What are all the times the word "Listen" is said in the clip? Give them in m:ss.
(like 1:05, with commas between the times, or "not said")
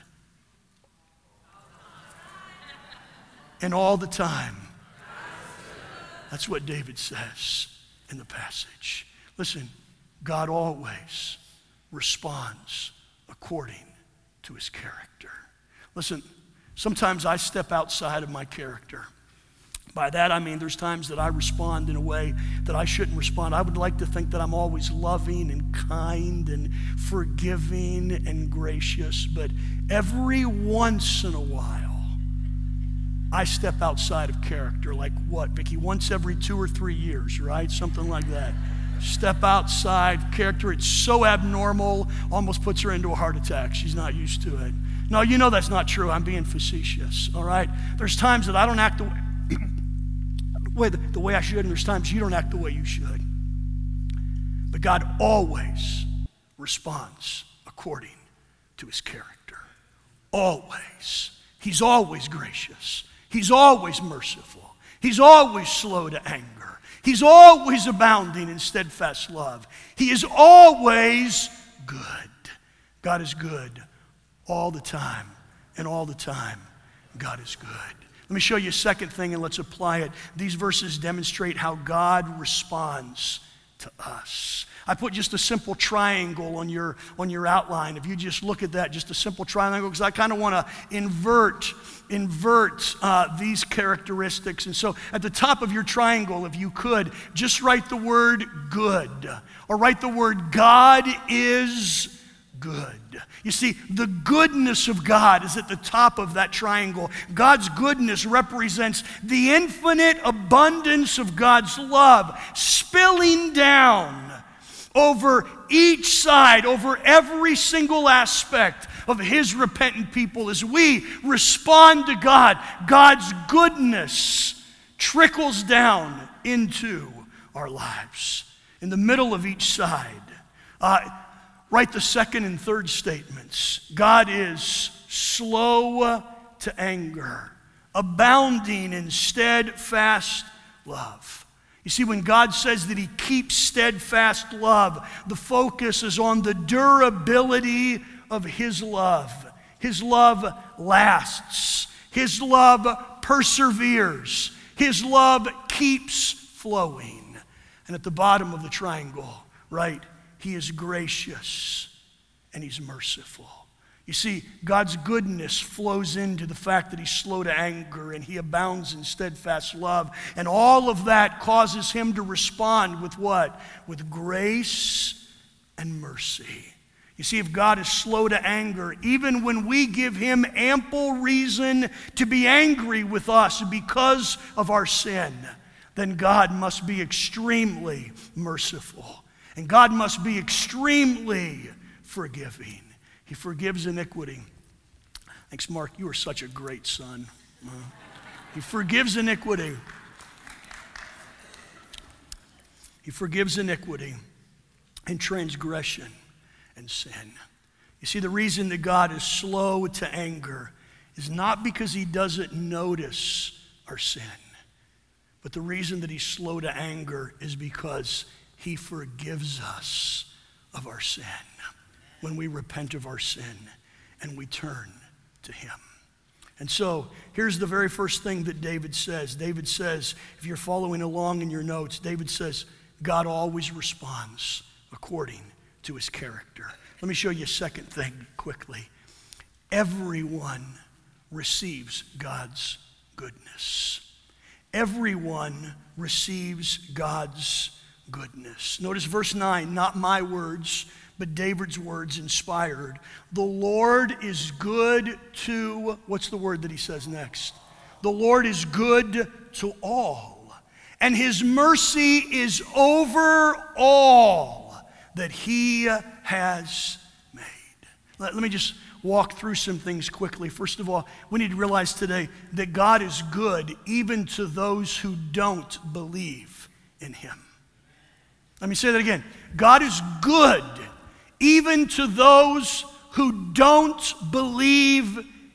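0:09, 0:15.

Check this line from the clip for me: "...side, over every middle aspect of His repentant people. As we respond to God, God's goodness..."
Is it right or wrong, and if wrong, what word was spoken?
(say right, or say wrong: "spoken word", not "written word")
wrong: "single", not "middle".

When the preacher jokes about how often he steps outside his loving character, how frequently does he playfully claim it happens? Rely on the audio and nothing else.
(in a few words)
Once every two or three years.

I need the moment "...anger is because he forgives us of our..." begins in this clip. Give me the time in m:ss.
3:36.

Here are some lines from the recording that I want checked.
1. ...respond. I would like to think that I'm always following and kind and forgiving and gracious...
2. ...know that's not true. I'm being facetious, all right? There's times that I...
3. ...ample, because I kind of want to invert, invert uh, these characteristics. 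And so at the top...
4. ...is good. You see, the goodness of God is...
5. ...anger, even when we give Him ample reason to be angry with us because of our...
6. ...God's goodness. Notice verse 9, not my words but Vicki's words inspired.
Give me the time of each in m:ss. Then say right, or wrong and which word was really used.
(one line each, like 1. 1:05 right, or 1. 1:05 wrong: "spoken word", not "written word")
1. 0:23 wrong: "loving", not "following"
2. 0:45 right
3. 1:29 wrong: "triangle", not "ample"
4. 1:41 right
5. 2:58 right
6. 4:06 wrong: "David", not "Vicki".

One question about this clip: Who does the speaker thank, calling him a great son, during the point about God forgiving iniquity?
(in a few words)
Mark.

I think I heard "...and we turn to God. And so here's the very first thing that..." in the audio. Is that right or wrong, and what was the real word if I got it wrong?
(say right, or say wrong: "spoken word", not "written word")
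wrong: "Him", not "God".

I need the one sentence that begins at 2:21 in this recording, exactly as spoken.
You see, when God says that He keeps steadfast love, the focus is on the durability of His love.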